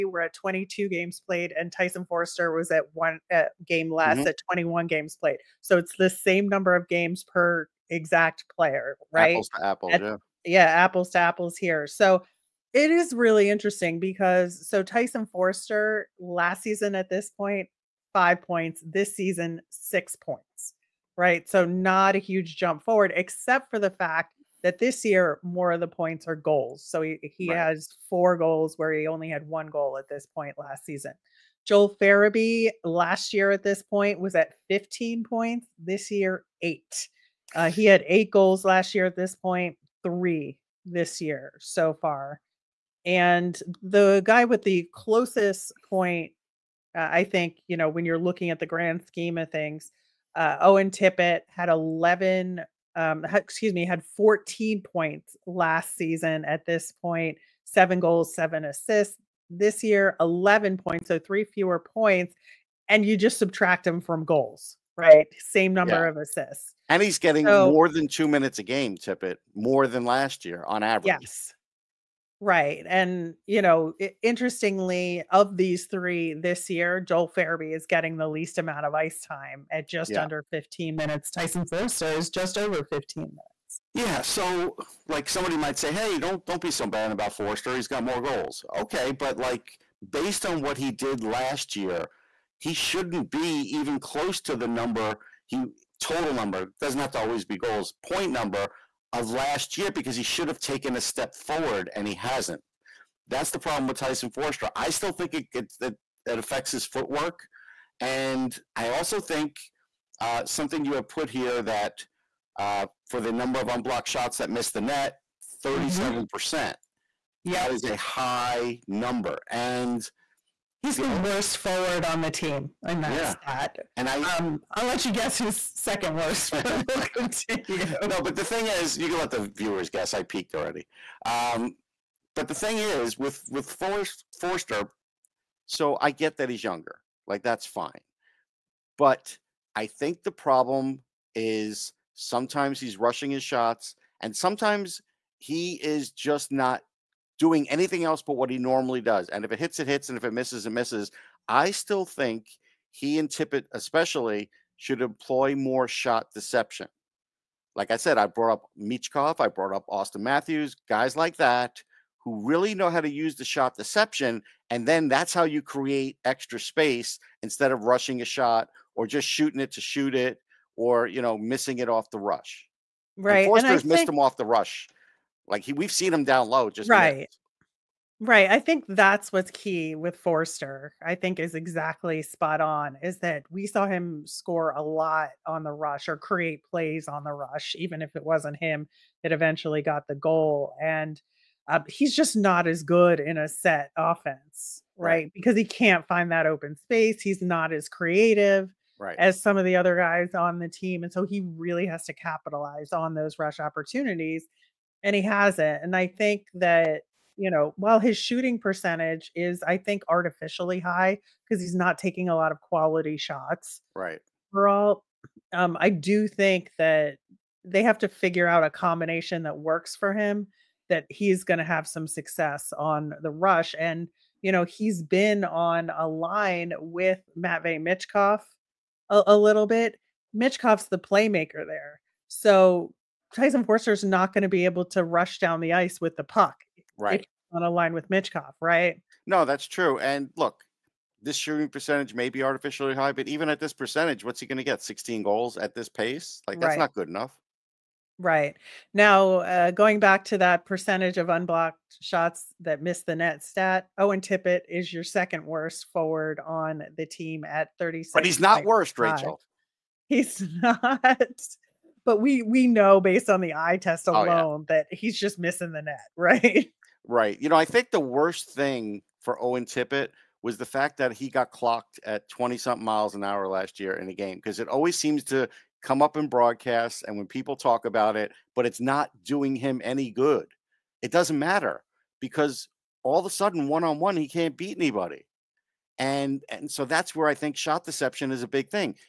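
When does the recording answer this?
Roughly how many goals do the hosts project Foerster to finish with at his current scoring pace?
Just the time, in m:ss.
4:04.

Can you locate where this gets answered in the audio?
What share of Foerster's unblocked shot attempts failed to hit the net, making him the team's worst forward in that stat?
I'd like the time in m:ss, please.
1:55.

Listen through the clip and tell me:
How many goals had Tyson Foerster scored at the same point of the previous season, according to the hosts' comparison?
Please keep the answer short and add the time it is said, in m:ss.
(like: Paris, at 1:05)
1, at 0:29.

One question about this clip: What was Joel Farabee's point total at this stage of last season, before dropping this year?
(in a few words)
15.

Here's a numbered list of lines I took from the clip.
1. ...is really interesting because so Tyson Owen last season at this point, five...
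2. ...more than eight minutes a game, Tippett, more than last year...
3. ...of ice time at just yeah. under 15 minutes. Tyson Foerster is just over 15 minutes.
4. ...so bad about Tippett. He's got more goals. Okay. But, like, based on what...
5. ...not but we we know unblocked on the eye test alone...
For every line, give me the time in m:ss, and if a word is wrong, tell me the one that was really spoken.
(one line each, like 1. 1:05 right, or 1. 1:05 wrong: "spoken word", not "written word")
1. 0:12 wrong: "Foerster", not "Owen"
2. 1:07 wrong: "two", not "eight"
3. 1:18 right
4. 1:26 wrong: "Foerster", not "Tippett"
5. 4:20 wrong: "based", not "unblocked".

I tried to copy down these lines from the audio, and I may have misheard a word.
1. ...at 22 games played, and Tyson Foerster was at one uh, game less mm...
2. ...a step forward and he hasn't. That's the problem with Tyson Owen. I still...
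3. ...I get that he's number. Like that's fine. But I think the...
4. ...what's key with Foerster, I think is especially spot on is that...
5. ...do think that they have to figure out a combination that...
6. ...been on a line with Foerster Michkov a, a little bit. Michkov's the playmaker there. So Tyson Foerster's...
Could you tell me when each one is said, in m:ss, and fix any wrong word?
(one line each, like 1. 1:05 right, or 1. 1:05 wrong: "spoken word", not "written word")
1. 0:00 right
2. 1:40 wrong: "Foerster", not "Owen"
3. 2:15 wrong: "younger", not "number"
4. 2:59 wrong: "exactly", not "especially"
5. 3:35 right
6. 3:45 wrong: "Matvei", not "Foerster".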